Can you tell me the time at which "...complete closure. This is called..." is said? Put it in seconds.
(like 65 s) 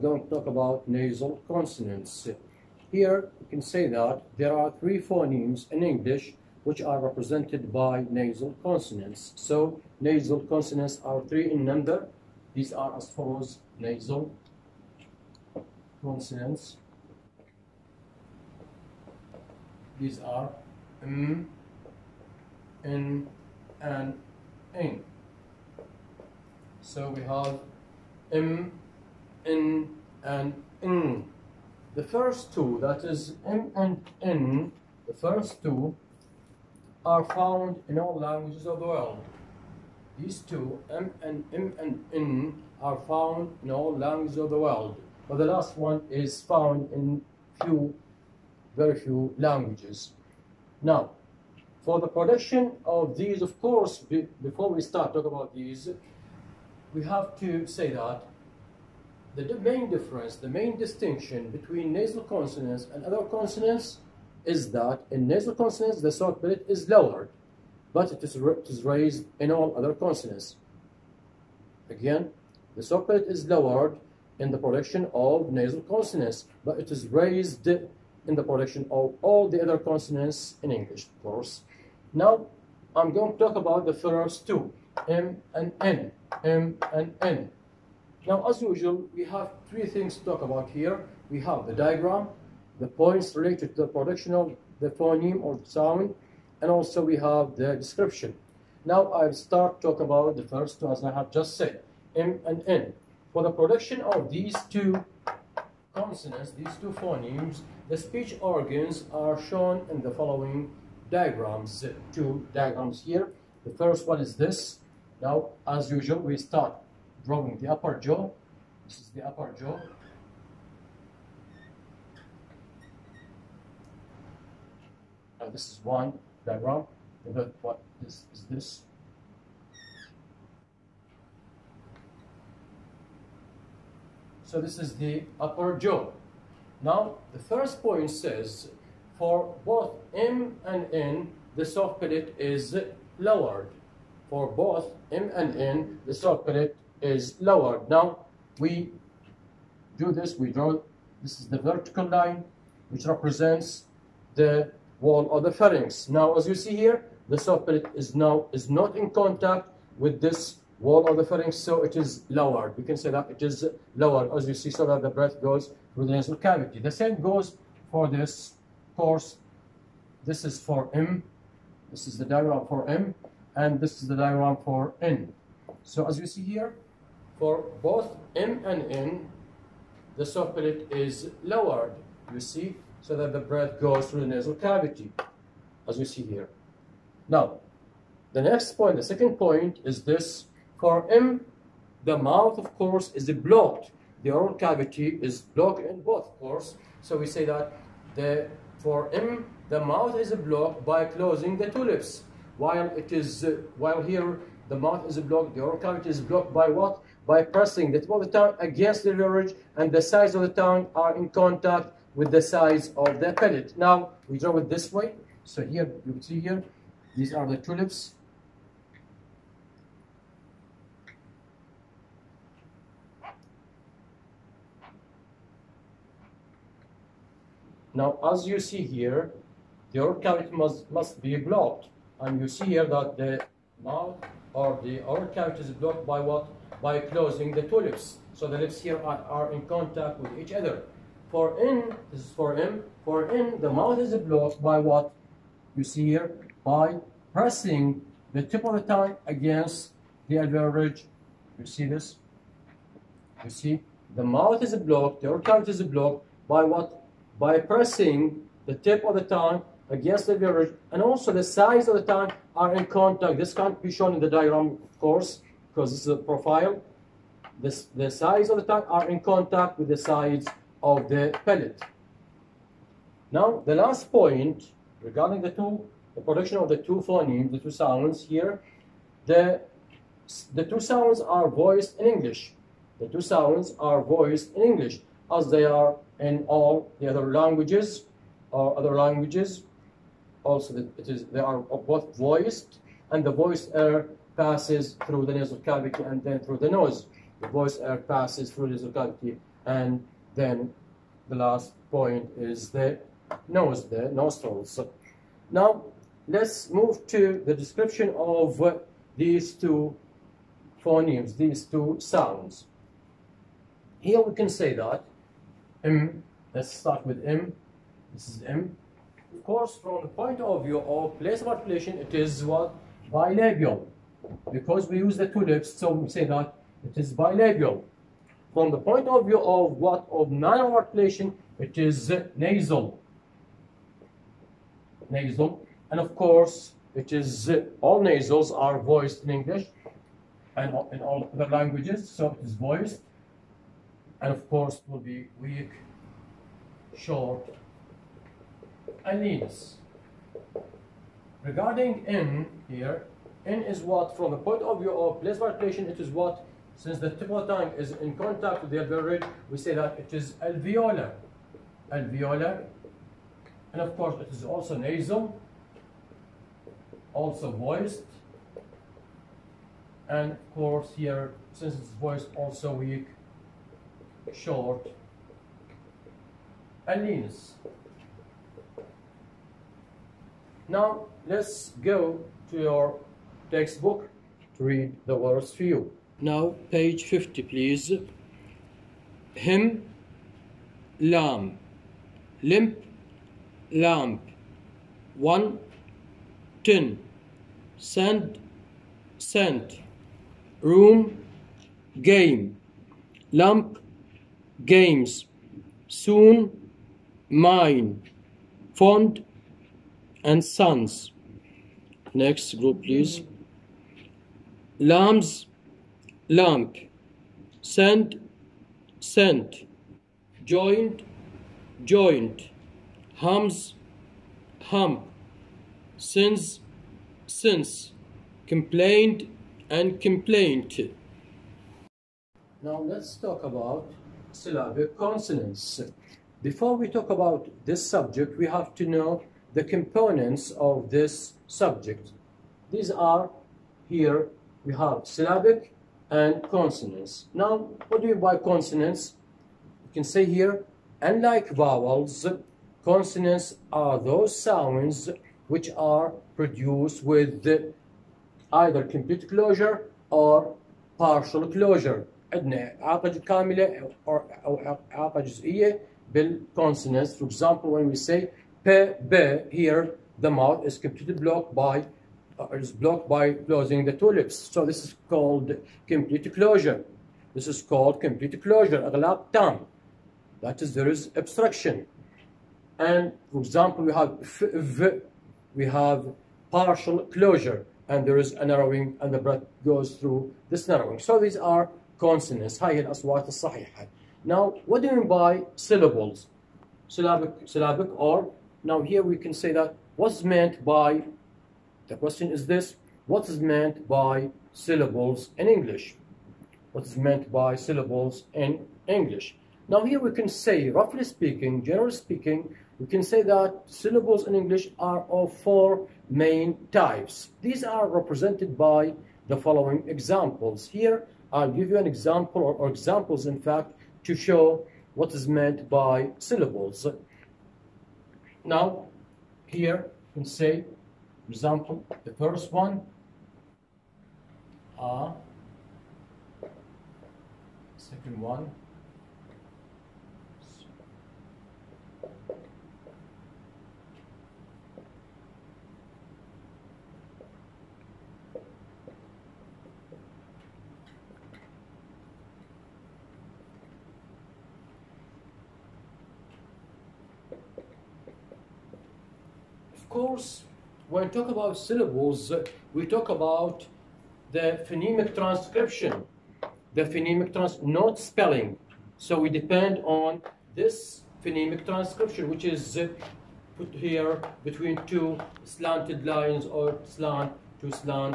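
475 s.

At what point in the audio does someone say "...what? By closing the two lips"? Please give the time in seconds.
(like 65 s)
236 s.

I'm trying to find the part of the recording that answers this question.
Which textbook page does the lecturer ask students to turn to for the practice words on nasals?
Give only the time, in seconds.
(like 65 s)
386 s.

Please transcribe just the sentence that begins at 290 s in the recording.
Also, it is, they are both voiced, and the voice air passes through the nasal cavity and then through the nose.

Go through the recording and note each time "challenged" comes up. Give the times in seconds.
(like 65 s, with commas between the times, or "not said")
not said.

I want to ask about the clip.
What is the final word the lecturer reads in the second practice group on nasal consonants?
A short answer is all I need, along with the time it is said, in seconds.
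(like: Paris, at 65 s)
complaint, at 430 s.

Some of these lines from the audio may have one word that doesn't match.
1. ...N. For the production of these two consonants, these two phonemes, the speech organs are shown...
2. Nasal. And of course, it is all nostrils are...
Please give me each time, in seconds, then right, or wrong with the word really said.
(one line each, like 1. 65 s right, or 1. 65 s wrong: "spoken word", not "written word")
1. 102 s right
2. 335 s wrong: "nasals", not "nostrils".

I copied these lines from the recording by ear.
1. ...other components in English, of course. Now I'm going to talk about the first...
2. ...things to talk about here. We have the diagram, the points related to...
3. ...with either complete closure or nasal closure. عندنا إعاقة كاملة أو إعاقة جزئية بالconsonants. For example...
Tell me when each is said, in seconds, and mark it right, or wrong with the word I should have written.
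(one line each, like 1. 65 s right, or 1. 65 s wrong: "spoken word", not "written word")
1. 79 s wrong: "consonants", not "components"
2. 89 s right
3. 457 s wrong: "partial", not "nasal".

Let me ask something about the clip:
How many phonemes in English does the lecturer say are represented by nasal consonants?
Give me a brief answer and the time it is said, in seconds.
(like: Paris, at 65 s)
3, at 4 s.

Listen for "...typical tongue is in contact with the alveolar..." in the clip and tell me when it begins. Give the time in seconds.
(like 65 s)
357 s.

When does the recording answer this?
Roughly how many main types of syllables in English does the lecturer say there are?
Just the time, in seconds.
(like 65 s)
515 s.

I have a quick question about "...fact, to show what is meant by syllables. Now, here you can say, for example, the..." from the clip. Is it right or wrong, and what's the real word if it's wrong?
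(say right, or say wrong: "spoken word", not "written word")
right.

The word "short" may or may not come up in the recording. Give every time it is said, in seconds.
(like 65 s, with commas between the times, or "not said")
346 s, 374 s.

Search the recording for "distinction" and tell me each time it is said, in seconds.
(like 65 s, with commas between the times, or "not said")
60 s.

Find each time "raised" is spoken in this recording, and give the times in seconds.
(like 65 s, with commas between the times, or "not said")
68 s, 77 s.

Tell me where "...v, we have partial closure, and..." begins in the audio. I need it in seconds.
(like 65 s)
484 s.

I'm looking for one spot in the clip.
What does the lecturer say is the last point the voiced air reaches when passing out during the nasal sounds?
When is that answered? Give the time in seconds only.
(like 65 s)
303 s.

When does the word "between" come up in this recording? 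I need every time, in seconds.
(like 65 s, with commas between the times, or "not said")
61 s, 574 s.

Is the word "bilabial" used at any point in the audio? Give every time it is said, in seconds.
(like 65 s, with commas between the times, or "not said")
323 s, 327 s.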